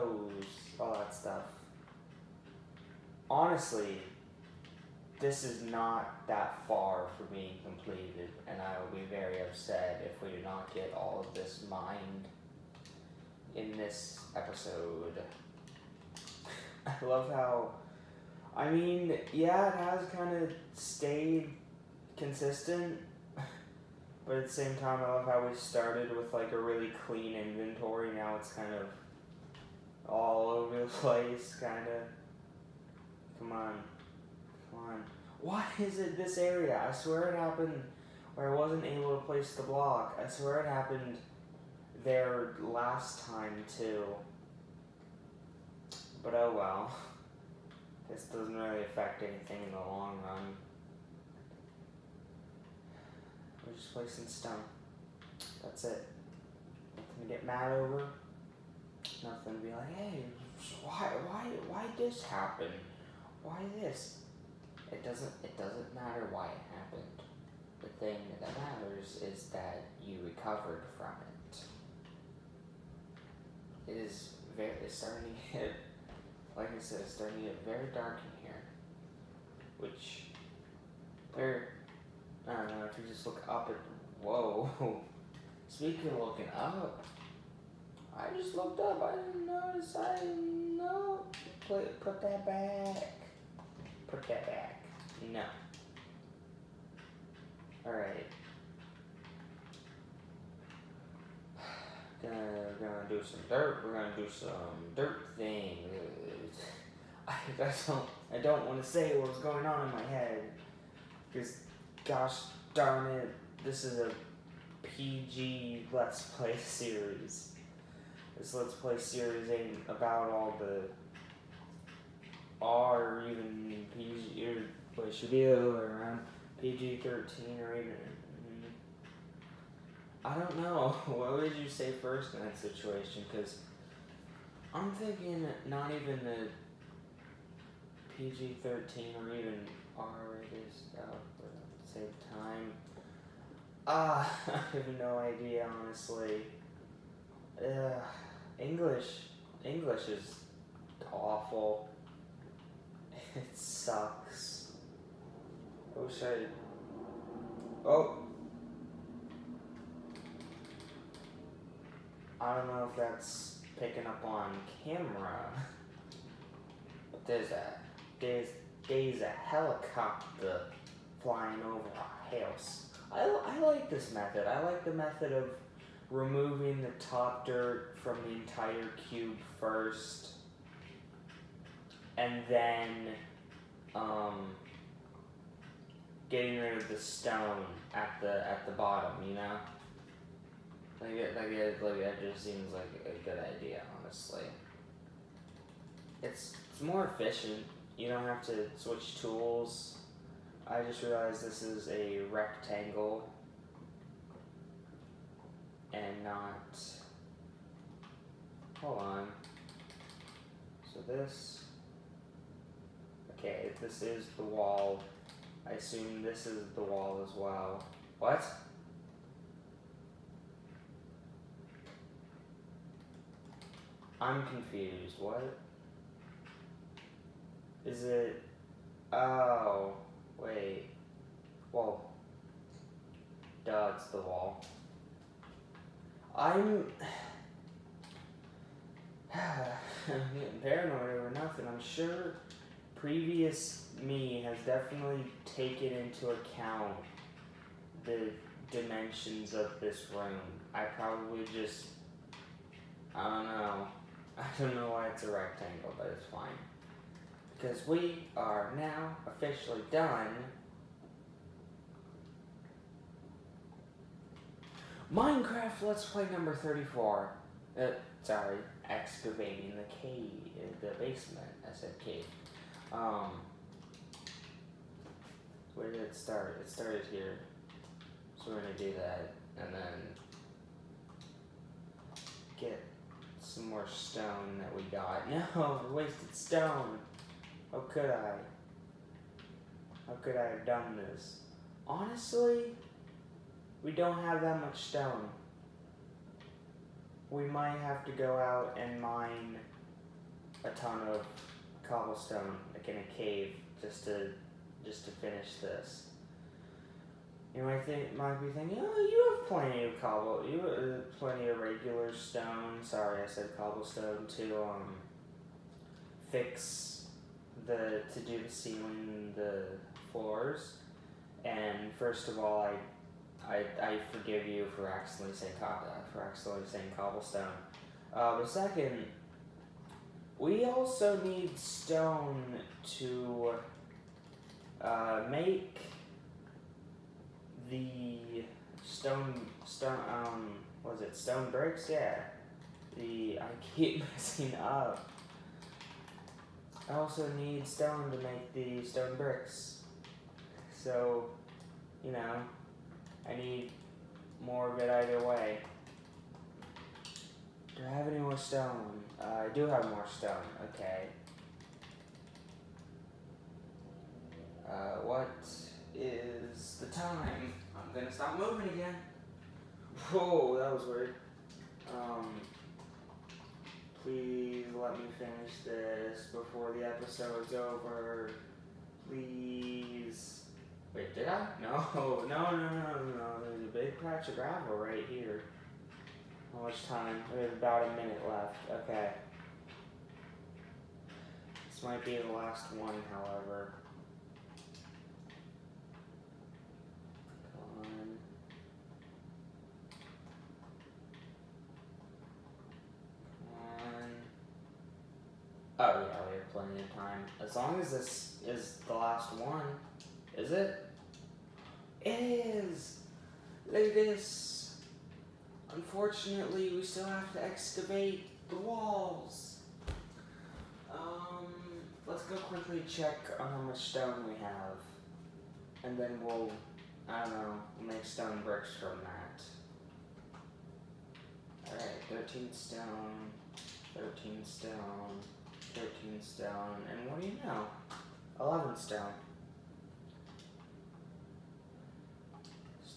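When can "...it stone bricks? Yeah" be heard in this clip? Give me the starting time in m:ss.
5:41.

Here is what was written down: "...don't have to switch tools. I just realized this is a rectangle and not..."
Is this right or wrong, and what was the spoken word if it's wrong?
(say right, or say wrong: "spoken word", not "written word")
right.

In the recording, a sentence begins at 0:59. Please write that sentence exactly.
Nothing to be like, hey, why, why, why this happen?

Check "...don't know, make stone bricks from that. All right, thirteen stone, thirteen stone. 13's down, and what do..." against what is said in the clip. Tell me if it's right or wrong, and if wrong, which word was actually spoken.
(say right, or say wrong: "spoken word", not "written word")
right.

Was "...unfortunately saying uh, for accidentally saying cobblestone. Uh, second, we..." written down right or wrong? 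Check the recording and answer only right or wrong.
wrong.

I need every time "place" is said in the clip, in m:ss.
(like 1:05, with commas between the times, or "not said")
0:30, 0:39, 0:53.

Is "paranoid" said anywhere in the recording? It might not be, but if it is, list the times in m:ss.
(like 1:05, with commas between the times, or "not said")
4:00.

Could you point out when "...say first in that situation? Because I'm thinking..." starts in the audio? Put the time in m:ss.
2:11.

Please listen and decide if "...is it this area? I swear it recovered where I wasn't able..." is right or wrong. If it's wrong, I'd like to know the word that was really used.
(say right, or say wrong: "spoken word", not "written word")
wrong: "happened", not "recovered".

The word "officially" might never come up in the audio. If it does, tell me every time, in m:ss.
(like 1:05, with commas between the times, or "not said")
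4:19.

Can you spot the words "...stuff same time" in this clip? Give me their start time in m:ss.
2:20.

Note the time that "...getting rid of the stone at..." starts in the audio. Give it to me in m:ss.
3:06.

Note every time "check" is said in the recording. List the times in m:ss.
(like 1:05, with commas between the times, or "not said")
7:02.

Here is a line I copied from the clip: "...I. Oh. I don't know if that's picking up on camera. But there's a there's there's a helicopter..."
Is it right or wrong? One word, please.
right.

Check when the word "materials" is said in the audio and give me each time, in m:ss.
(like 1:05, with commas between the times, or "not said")
not said.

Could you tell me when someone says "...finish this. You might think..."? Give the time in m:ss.
5:05.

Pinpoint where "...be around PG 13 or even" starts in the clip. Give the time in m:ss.
2:05.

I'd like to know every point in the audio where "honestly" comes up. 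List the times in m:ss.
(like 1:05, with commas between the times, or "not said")
0:03, 2:25, 3:13, 4:51.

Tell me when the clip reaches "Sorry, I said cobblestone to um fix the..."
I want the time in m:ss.
5:12.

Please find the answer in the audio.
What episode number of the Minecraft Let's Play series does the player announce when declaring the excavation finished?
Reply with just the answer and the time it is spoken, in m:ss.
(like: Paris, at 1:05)
34, at 4:26.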